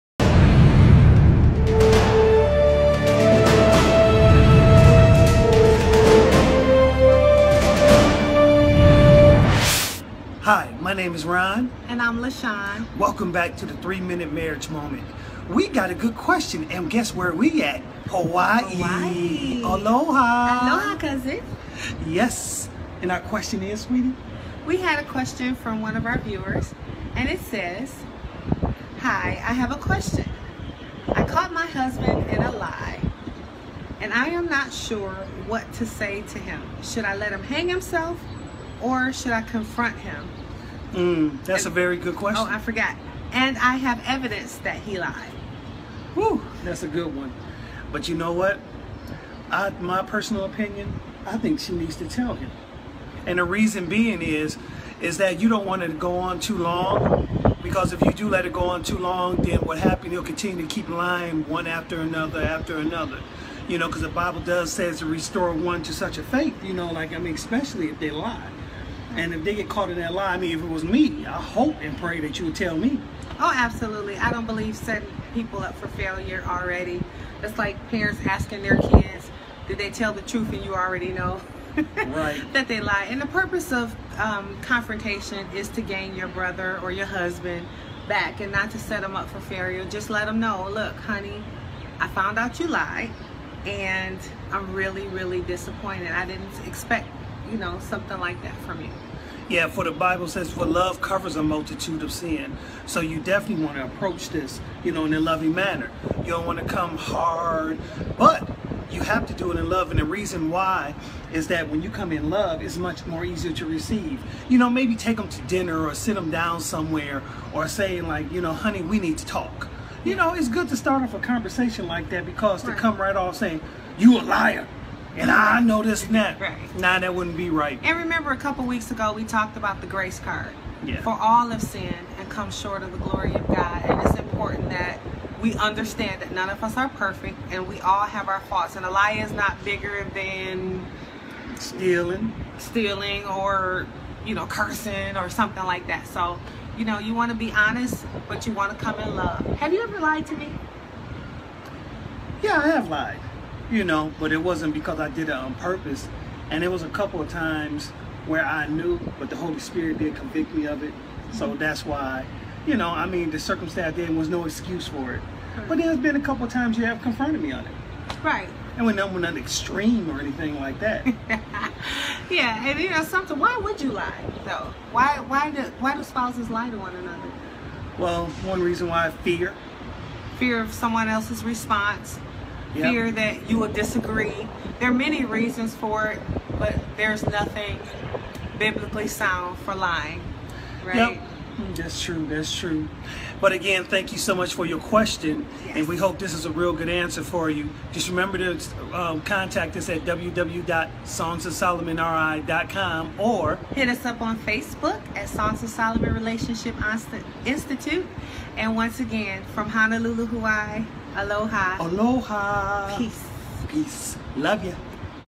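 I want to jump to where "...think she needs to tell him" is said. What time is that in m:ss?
0:51.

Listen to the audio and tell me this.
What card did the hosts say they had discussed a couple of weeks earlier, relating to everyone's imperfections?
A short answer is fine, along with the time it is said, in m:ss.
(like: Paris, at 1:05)
the grace card, at 2:09.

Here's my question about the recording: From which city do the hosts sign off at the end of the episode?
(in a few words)
Honolulu.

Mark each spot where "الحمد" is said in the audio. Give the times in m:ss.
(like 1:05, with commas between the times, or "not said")
not said.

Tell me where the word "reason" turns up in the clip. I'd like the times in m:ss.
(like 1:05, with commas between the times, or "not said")
0:53, 1:50, 2:58, 3:05.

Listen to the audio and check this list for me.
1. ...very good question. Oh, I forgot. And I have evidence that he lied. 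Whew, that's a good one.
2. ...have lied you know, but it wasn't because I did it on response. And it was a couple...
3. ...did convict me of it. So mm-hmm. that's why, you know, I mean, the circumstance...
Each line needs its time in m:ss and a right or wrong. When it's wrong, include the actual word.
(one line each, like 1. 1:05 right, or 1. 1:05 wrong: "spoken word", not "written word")
1. 0:41 right
2. 2:32 wrong: "purpose", not "response"
3. 2:39 right.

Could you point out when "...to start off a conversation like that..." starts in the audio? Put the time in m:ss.
2:00.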